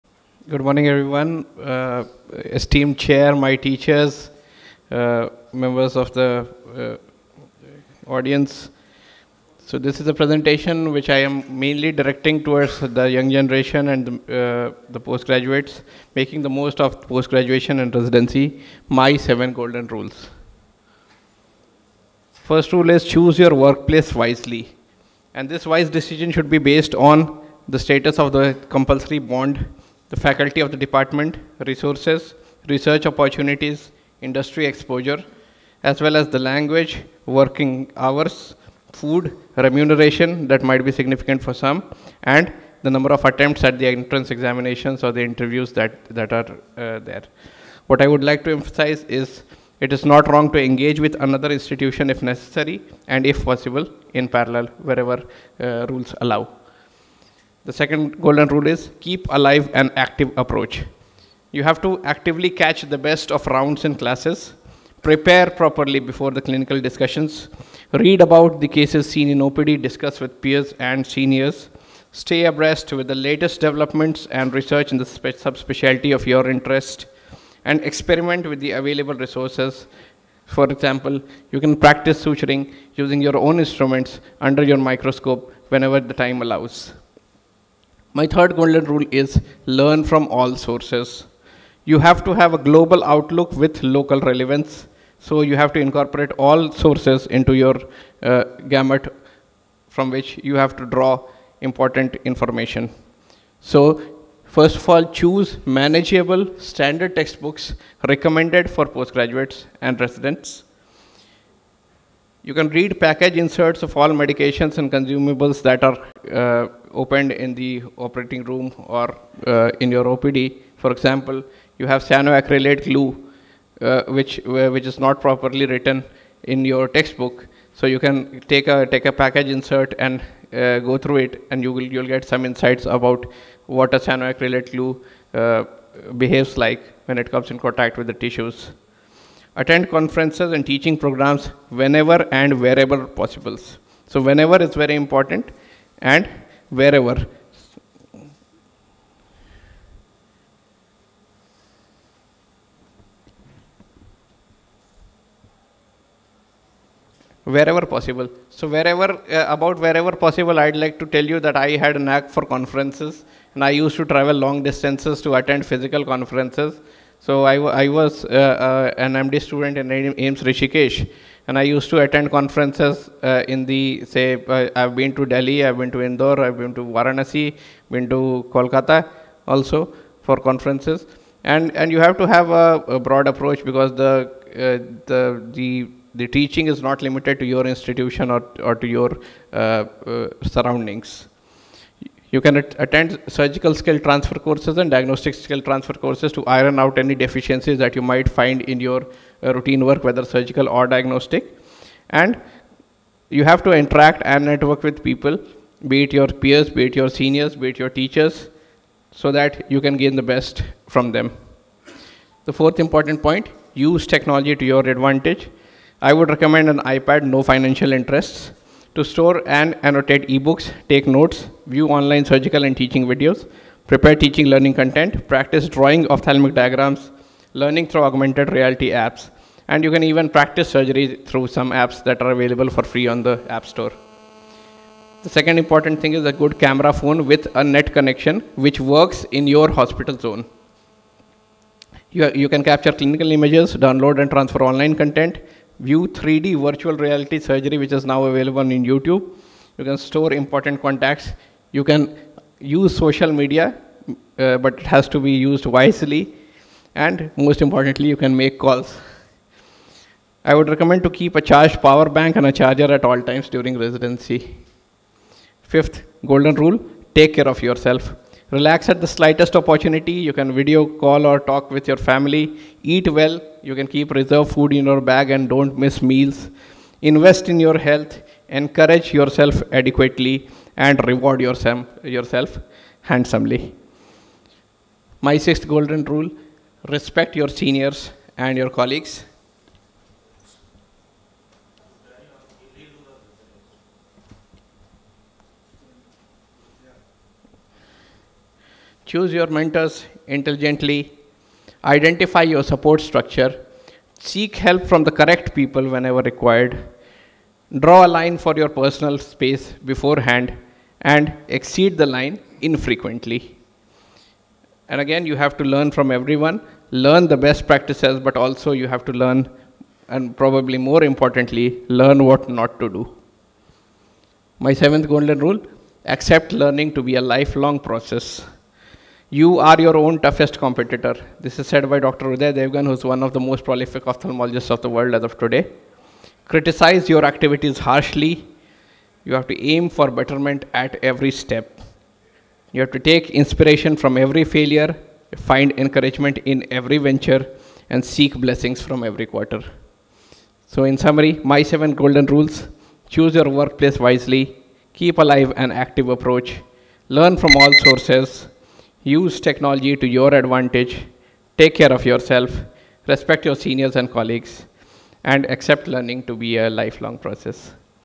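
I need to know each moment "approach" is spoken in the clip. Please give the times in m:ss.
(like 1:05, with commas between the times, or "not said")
1:00, 3:03, 5:56.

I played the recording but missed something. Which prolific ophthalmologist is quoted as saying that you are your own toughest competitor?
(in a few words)
Dr. Uday Devgan.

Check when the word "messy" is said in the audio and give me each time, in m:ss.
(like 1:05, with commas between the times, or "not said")
not said.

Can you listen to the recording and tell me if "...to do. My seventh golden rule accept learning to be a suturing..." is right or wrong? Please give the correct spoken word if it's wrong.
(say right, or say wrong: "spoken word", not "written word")
wrong: "lifelong", not "suturing".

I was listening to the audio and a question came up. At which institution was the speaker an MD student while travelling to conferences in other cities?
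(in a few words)
AIIMS Rishikesh.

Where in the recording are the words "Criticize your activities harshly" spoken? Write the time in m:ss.
5:36.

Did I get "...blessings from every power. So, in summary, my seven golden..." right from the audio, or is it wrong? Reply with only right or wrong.
wrong.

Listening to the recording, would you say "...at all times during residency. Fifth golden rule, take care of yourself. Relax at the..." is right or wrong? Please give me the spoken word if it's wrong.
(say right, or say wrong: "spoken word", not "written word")
right.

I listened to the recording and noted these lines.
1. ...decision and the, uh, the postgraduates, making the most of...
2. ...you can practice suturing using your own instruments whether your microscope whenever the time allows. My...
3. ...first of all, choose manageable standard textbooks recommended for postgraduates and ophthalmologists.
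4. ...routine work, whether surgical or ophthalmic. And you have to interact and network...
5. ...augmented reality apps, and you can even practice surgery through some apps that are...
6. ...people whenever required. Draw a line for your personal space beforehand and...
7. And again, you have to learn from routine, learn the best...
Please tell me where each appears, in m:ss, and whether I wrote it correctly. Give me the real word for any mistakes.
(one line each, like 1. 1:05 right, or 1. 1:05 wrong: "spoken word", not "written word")
1. 0:13 wrong: "generation", not "decision"
2. 1:21 wrong: "under", not "whether"
3. 1:44 wrong: "residents", not "ophthalmologists"
4. 3:19 wrong: "diagnostic", not "ophthalmic"
5. 3:48 right
6. 5:05 right
7. 5:14 wrong: "everyone", not "routine".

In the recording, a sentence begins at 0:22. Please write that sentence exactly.
First rule is choose your workplace wisely.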